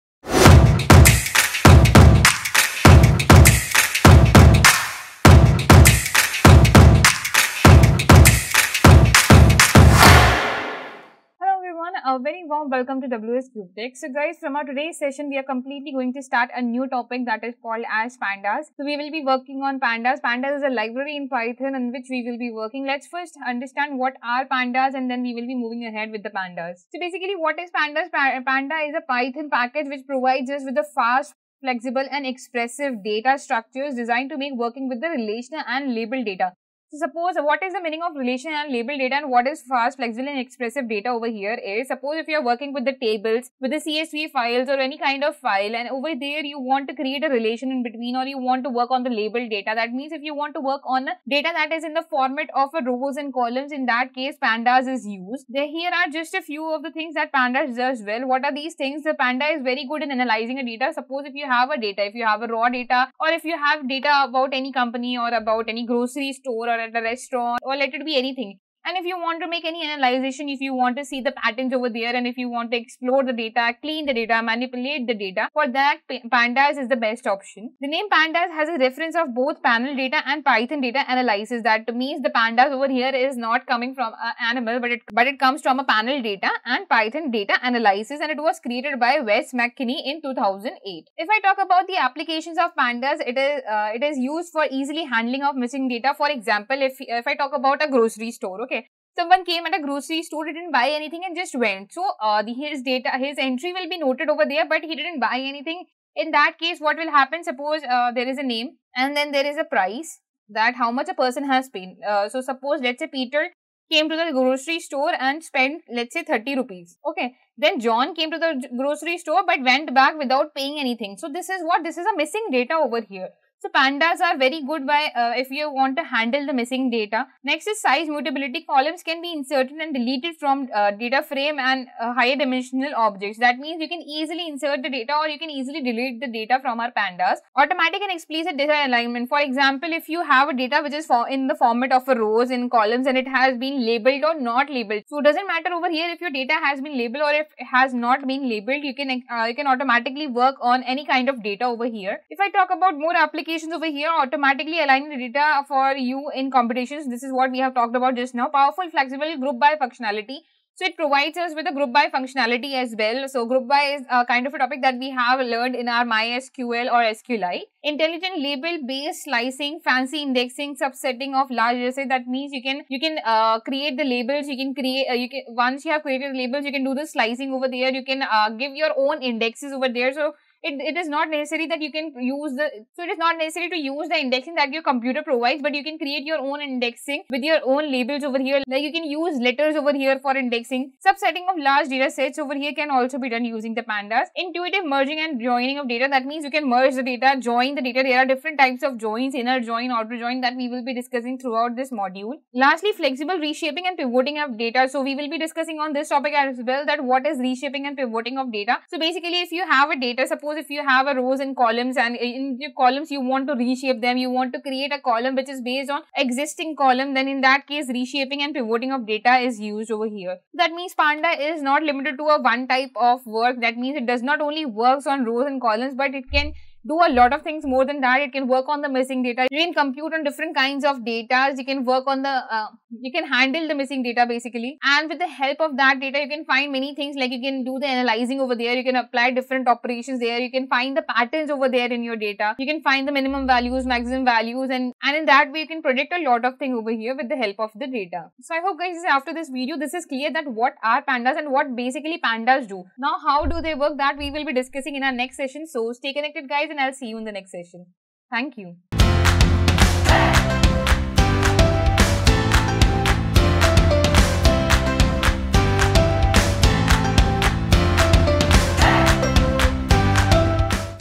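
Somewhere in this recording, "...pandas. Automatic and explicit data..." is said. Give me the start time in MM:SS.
02:16.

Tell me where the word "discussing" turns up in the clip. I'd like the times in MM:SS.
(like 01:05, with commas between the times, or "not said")
03:20, 03:25, 04:14.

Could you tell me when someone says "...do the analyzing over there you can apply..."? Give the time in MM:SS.
03:57.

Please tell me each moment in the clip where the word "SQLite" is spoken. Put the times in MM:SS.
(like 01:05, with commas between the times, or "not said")
02:47.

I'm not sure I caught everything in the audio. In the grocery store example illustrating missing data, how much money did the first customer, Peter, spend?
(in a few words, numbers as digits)
30 rupees.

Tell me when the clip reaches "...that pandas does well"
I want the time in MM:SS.
00:57.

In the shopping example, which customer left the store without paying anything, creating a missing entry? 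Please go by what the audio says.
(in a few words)
John.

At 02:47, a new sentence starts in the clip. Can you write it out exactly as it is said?
Intelligent label based slicing, fancy indexing, subsetting of large data That means you can you can uh, create the labels.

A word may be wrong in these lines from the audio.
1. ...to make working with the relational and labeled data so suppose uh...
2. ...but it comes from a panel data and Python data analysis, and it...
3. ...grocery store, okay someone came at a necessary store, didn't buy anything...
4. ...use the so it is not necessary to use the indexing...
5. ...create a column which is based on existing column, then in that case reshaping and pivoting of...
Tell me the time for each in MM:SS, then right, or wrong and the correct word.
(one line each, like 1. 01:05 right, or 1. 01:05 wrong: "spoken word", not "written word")
1. 00:34 right
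2. 01:25 right
3. 01:37 wrong: "grocery", not "necessary"
4. 03:02 right
5. 03:34 right.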